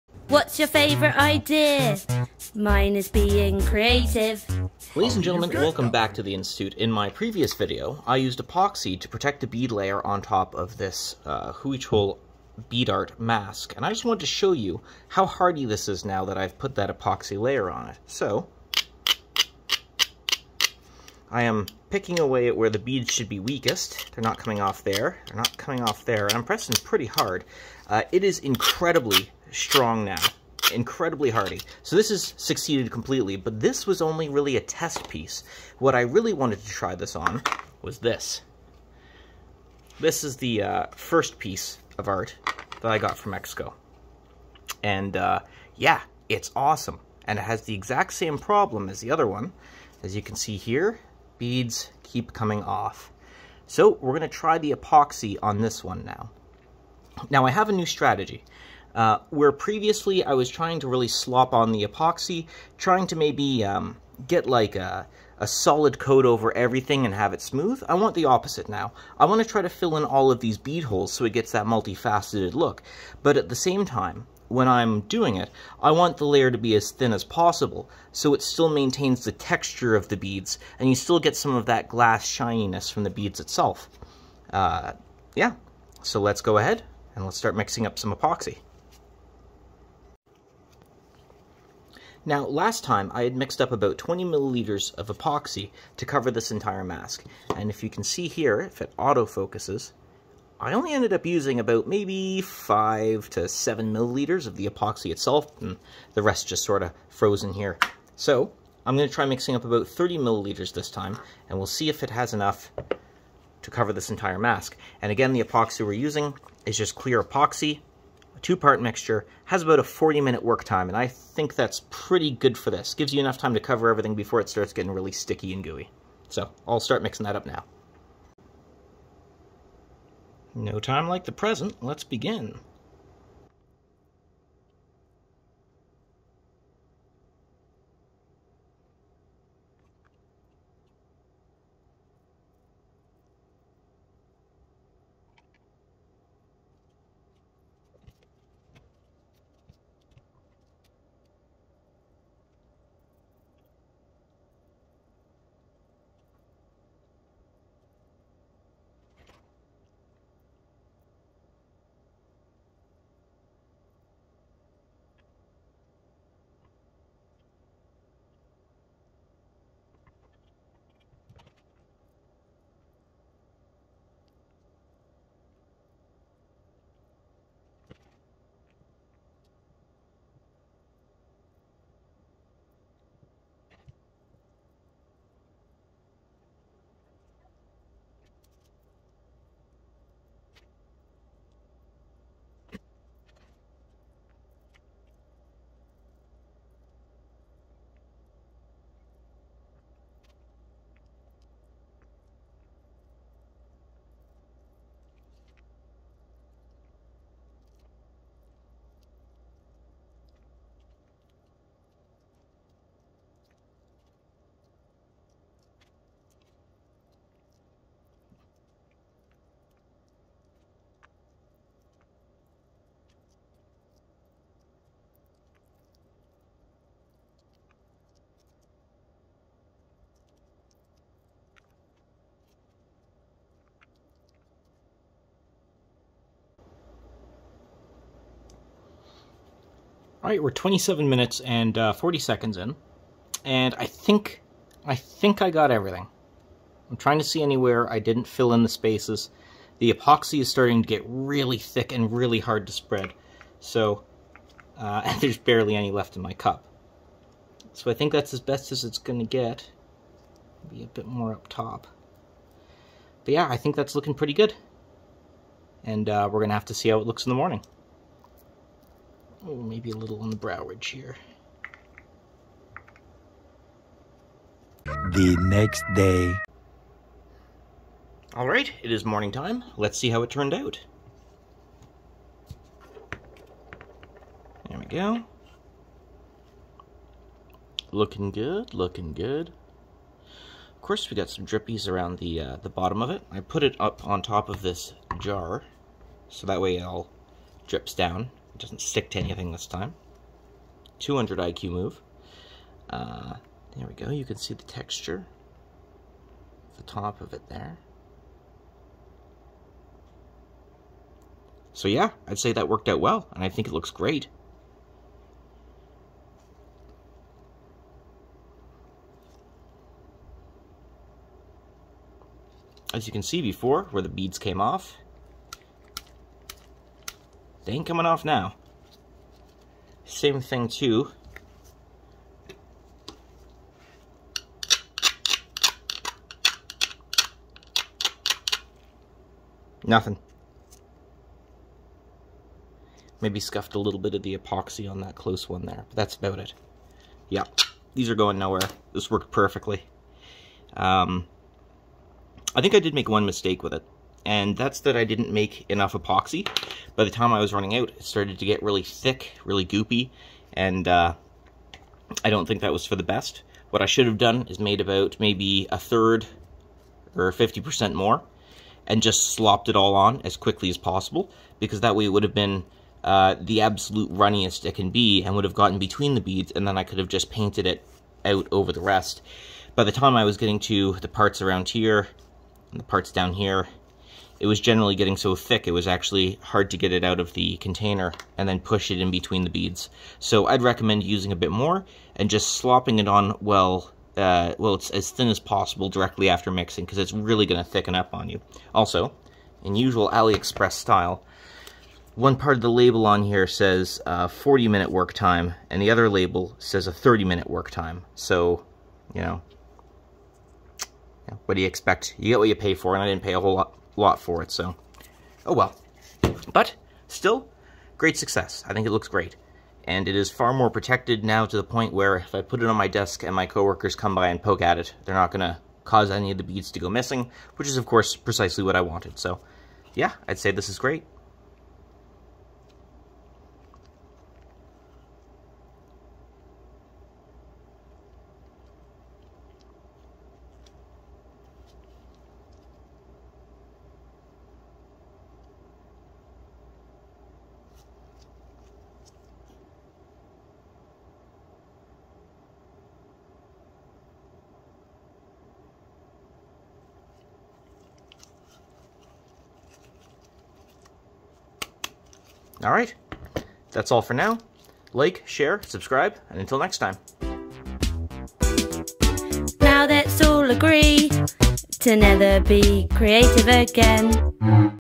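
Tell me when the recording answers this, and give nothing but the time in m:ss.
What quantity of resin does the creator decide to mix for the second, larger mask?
1:49.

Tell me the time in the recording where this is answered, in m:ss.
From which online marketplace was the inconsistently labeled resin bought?
6:40.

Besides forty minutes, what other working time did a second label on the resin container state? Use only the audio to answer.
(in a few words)
30 minutes.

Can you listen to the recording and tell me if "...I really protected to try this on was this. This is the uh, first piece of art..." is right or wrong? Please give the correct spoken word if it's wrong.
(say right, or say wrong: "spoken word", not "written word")
wrong: "wanted", not "protected".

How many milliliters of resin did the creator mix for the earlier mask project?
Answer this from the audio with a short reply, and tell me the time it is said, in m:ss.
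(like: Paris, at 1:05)
20 milliliters, at 1:33.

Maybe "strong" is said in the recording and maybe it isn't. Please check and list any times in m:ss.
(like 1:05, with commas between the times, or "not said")
0:29.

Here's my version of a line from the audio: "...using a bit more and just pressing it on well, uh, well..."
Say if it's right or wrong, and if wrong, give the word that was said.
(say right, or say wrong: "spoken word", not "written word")
wrong: "slopping", not "pressing".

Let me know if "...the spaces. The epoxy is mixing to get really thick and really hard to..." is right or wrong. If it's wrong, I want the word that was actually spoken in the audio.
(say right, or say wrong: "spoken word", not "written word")
wrong: "starting", not "mixing".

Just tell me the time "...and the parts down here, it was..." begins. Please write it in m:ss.
6:22.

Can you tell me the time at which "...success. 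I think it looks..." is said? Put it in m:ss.
6:58.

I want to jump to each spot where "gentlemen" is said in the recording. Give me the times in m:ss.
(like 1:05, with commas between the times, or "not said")
0:05.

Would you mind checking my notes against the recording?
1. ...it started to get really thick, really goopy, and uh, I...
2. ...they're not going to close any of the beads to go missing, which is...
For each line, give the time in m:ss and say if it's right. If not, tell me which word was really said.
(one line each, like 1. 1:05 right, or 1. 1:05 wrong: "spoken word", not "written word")
1. 5:57 right
2. 7:05 wrong: "cause", not "close".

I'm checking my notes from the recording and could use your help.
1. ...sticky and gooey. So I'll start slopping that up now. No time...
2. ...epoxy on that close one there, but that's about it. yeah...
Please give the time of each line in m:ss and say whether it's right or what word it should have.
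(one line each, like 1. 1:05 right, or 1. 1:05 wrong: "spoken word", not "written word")
1. 2:05 wrong: "mixing", not "slopping"
2. 5:44 right.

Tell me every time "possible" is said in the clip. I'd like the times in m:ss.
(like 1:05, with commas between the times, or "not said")
1:17, 6:10, 6:35.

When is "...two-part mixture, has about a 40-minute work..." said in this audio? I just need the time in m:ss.
1:58.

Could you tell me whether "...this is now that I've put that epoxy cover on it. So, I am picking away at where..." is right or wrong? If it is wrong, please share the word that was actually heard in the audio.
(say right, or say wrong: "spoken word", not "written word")
wrong: "layer", not "cover".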